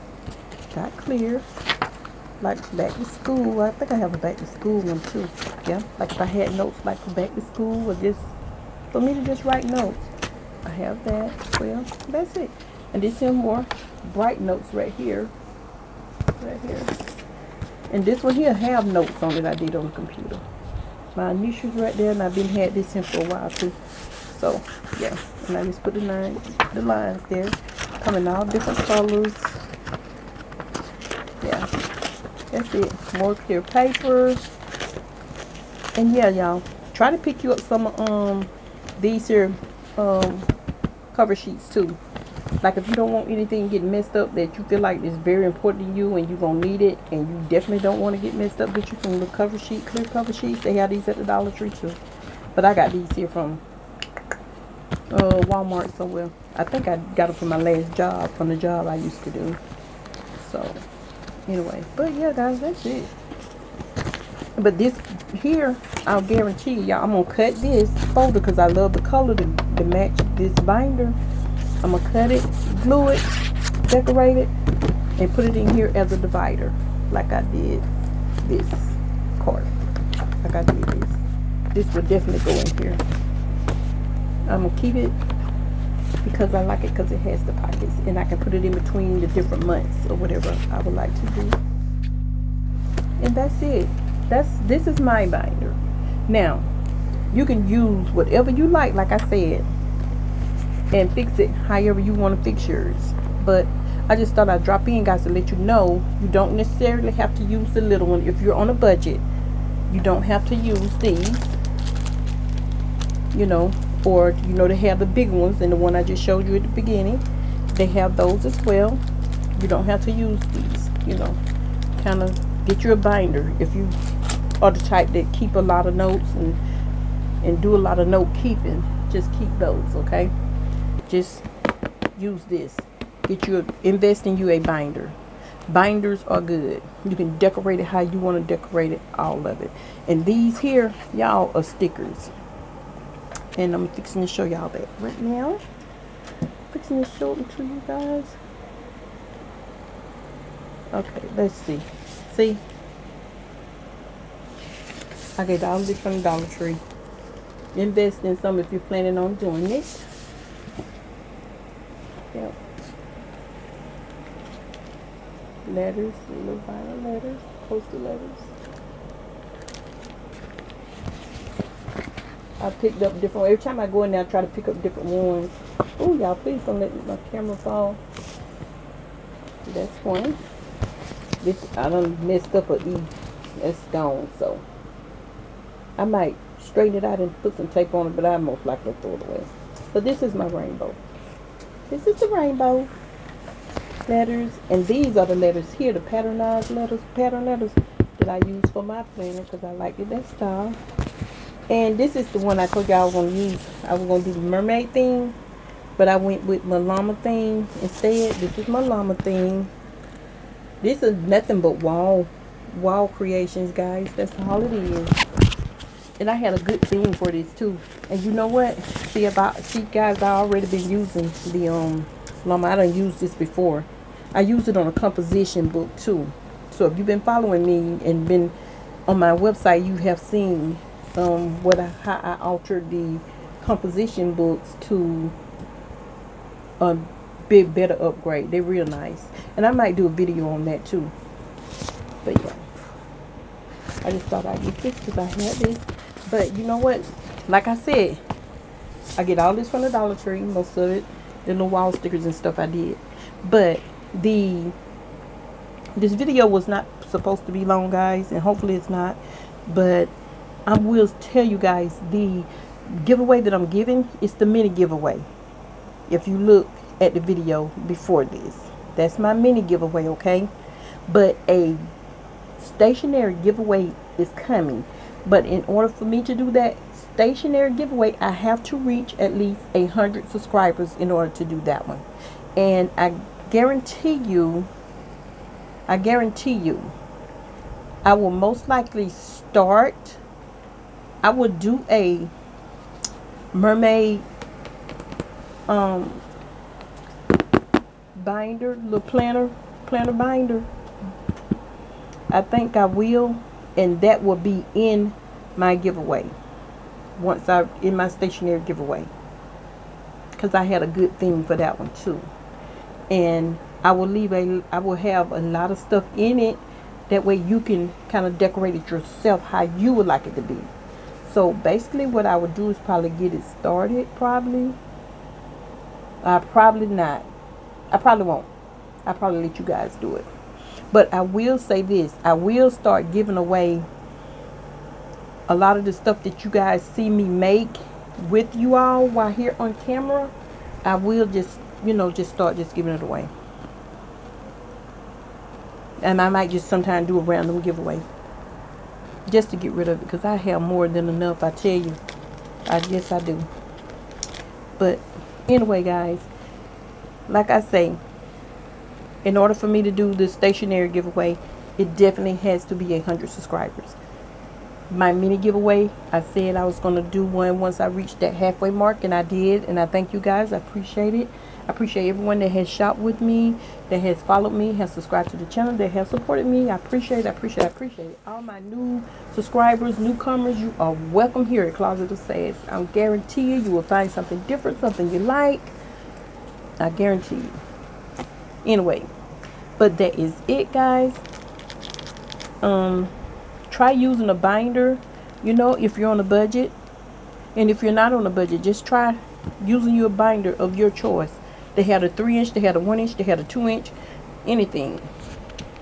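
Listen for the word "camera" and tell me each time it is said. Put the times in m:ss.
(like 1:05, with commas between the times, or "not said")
2:57, 5:39.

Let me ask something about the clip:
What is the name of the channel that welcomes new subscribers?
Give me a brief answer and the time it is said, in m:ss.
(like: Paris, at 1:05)
Closet of Sass, at 6:21.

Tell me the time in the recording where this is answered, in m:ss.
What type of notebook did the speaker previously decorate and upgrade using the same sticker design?
3:44.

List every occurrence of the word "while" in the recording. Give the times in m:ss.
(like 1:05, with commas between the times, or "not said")
0:23, 5:39.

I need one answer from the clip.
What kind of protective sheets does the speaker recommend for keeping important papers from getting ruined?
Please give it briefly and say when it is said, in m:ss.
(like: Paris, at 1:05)
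clear cover sheets, at 0:49.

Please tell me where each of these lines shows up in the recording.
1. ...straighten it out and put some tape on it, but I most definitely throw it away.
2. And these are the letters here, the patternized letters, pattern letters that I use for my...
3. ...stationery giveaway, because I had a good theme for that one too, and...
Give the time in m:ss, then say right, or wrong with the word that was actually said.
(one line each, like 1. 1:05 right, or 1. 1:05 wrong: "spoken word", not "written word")
1. 3:06 wrong: "likely", not "definitely"
2. 3:14 right
3. 5:08 right.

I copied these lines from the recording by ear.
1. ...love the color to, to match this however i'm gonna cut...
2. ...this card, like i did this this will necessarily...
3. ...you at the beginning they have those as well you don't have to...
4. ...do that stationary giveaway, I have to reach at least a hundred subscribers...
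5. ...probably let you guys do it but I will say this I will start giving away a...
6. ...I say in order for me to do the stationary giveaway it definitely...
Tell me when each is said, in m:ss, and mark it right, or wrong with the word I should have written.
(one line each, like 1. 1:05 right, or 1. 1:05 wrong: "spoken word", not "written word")
1. 1:08 wrong: "binder", not "however"
2. 1:18 wrong: "definitely", not "necessarily"
3. 1:56 right
4. 4:36 right
5. 5:29 right
6. 5:57 right.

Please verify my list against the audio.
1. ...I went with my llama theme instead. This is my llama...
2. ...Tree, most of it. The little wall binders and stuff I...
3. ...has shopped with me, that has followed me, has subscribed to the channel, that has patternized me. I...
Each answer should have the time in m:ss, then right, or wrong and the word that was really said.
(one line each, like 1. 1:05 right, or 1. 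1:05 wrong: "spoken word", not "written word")
1. 3:26 right
2. 4:10 wrong: "stickers", not "binders"
3. 6:12 wrong: "supported", not "patternized".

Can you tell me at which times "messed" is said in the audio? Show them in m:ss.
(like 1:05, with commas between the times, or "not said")
0:43, 0:48, 3:02.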